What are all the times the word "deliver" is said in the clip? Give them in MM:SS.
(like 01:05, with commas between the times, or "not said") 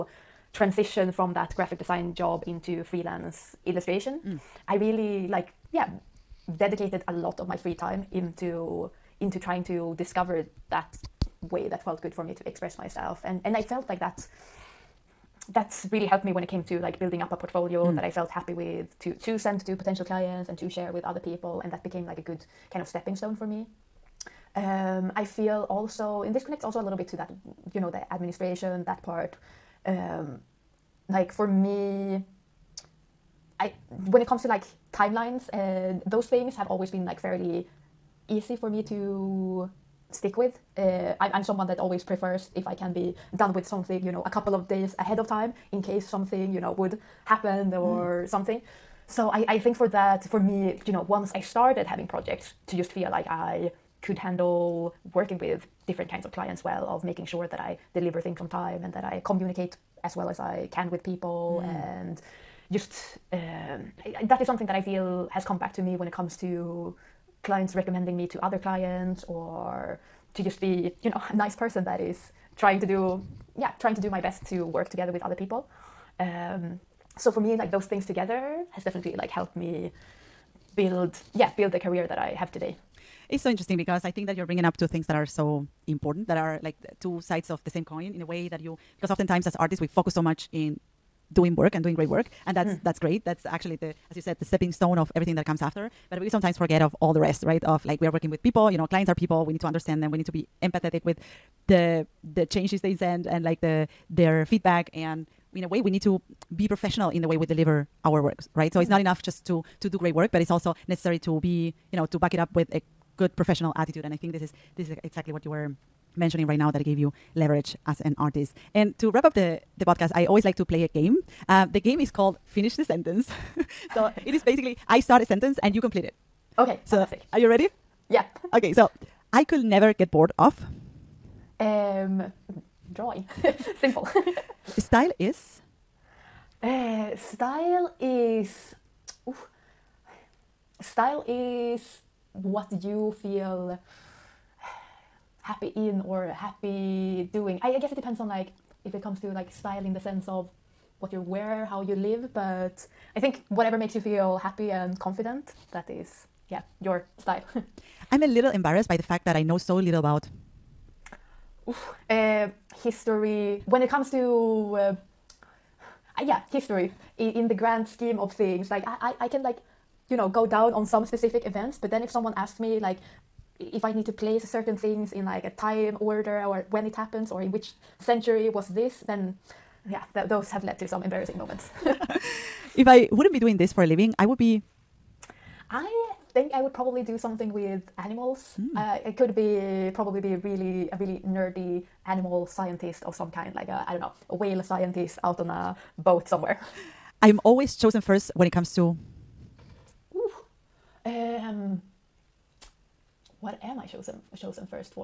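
00:57, 01:47.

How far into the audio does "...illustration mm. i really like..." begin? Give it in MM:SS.
00:03.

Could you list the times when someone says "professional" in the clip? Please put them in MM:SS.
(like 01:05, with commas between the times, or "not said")
01:46, 01:53.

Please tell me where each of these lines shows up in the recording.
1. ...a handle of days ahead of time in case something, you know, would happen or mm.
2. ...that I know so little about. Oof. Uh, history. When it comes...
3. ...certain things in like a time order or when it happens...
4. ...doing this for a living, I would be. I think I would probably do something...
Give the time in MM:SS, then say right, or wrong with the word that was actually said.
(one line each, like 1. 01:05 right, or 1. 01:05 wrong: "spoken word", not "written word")
1. 00:44 wrong: "couple", not "handle"
2. 02:39 right
3. 02:54 right
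4. 03:03 right.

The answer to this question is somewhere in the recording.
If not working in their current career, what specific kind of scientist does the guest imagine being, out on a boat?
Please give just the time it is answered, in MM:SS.
03:14.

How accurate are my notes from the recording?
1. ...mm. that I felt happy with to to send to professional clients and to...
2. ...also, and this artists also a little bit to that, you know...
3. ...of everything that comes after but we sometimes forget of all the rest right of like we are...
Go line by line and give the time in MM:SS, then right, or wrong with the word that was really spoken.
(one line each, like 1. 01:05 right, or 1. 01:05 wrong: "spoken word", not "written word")
1. 00:17 wrong: "potential", not "professional"
2. 00:25 wrong: "connects", not "artists"
3. 01:34 right.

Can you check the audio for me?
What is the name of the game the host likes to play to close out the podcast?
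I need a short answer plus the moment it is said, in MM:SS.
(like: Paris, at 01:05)
finish the sentence, at 02:02.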